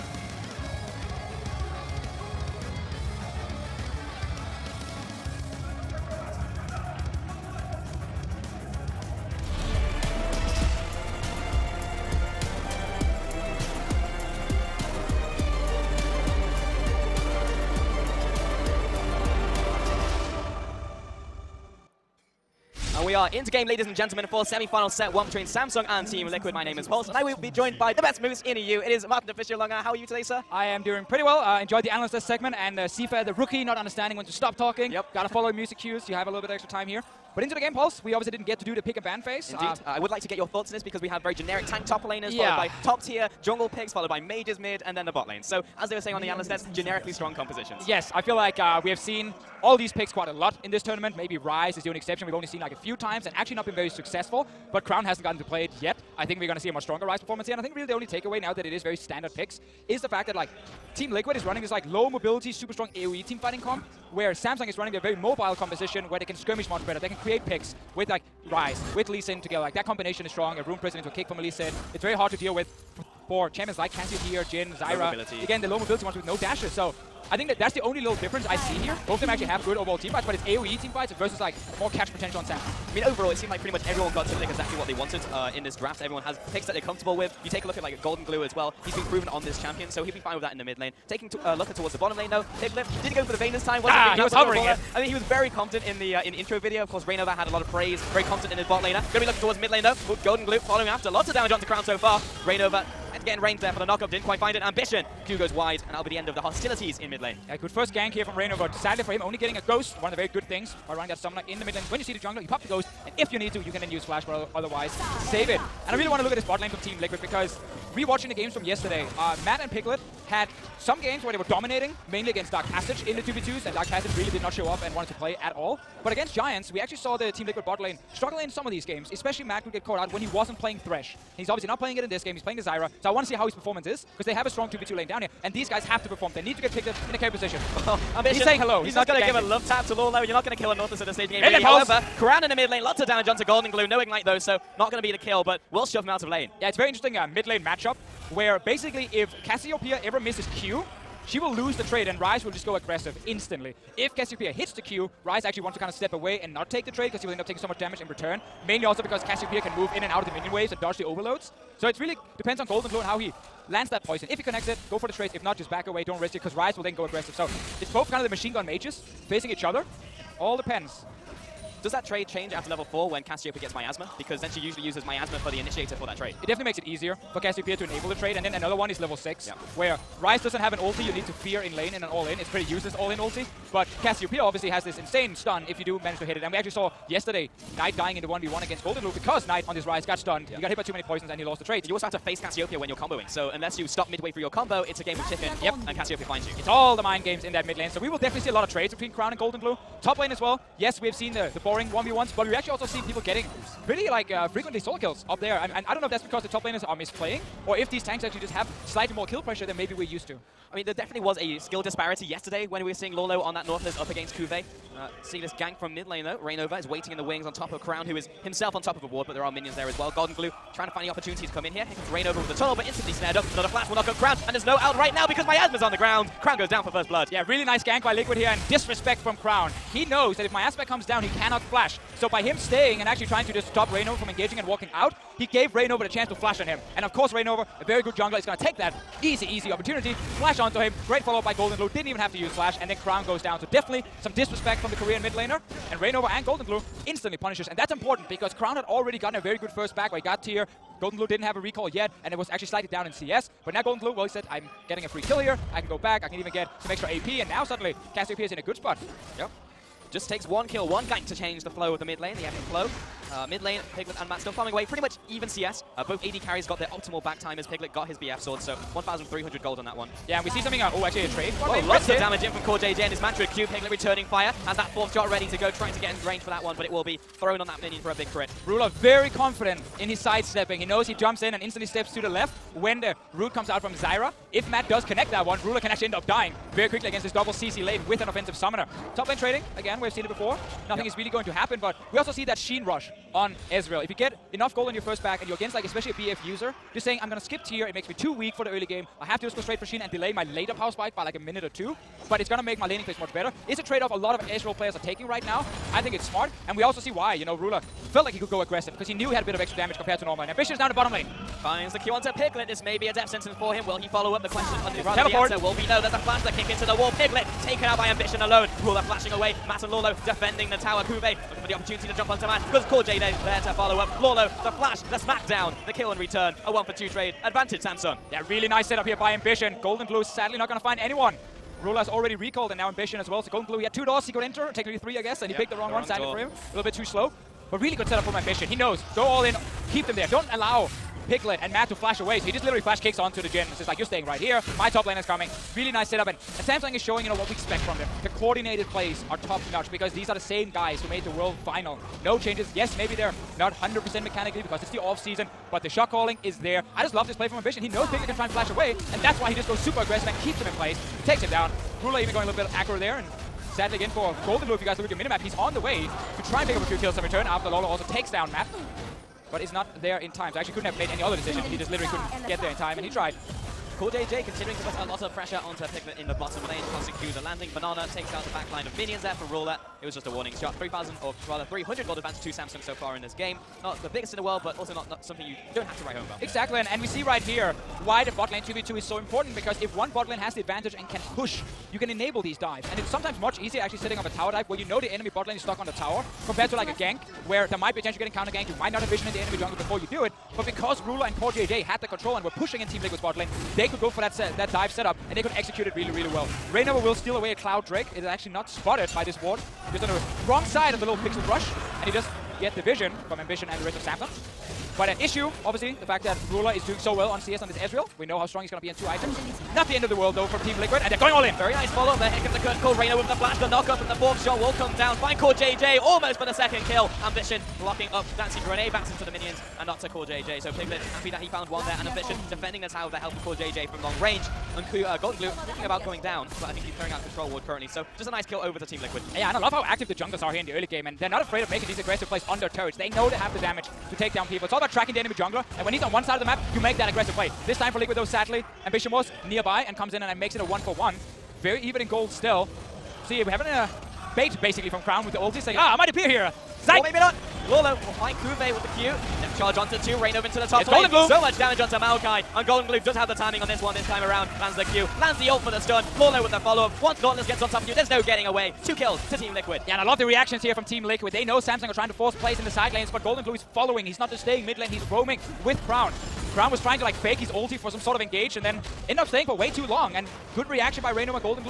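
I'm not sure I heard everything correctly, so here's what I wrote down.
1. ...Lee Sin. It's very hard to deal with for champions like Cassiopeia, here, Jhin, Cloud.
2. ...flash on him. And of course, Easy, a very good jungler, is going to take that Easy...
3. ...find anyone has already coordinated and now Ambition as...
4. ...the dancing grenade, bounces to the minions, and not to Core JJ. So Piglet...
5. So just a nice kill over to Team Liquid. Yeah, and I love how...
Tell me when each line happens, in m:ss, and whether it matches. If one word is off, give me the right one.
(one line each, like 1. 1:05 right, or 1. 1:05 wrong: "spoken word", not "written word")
1. 1:11 wrong: "Zyra", not "Cloud"
2. 3:56 wrong: "Reignover", not "Easy"
3. 5:30 wrong: "recalled", not "coordinated"
4. 7:08 right
5. 7:17 right.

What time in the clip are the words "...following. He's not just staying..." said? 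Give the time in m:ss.
7:53.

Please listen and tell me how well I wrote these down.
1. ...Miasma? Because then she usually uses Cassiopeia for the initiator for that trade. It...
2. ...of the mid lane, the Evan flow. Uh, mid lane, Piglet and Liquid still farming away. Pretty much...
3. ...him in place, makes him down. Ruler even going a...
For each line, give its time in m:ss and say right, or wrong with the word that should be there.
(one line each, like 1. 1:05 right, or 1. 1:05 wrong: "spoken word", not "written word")
1. 2:53 wrong: "Miasma", not "Cassiopeia"
2. 4:21 wrong: "Matt", not "Liquid"
3. 6:00 wrong: "takes", not "makes".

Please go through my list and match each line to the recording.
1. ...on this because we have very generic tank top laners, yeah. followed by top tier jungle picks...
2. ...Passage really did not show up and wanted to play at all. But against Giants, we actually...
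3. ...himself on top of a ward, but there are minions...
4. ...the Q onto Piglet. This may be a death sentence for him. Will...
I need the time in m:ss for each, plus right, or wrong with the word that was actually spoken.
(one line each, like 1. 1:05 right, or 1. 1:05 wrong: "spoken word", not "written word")
1. 0:40 right
2. 2:03 right
3. 3:38 right
4. 5:11 right.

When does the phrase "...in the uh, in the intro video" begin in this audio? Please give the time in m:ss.
1:35.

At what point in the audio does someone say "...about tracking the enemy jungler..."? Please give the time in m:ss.
7:24.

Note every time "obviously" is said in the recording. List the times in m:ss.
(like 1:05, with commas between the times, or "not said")
0:38, 2:11, 3:04, 6:55.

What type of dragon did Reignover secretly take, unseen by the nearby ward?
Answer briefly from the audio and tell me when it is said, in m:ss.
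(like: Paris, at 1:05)
Cloud Drake, at 6:47.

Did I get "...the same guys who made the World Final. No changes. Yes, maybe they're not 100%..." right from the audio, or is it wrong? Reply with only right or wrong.
right.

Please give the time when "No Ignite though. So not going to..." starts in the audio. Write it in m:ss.
2:23.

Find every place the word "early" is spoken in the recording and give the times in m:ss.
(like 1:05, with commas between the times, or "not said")
4:58, 7:20.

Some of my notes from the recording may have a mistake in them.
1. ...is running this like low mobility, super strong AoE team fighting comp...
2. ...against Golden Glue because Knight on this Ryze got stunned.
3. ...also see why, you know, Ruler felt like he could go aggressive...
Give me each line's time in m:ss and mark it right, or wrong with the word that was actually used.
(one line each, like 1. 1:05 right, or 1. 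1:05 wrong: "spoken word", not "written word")
1. 1:01 right
2. 3:08 right
3. 5:06 right.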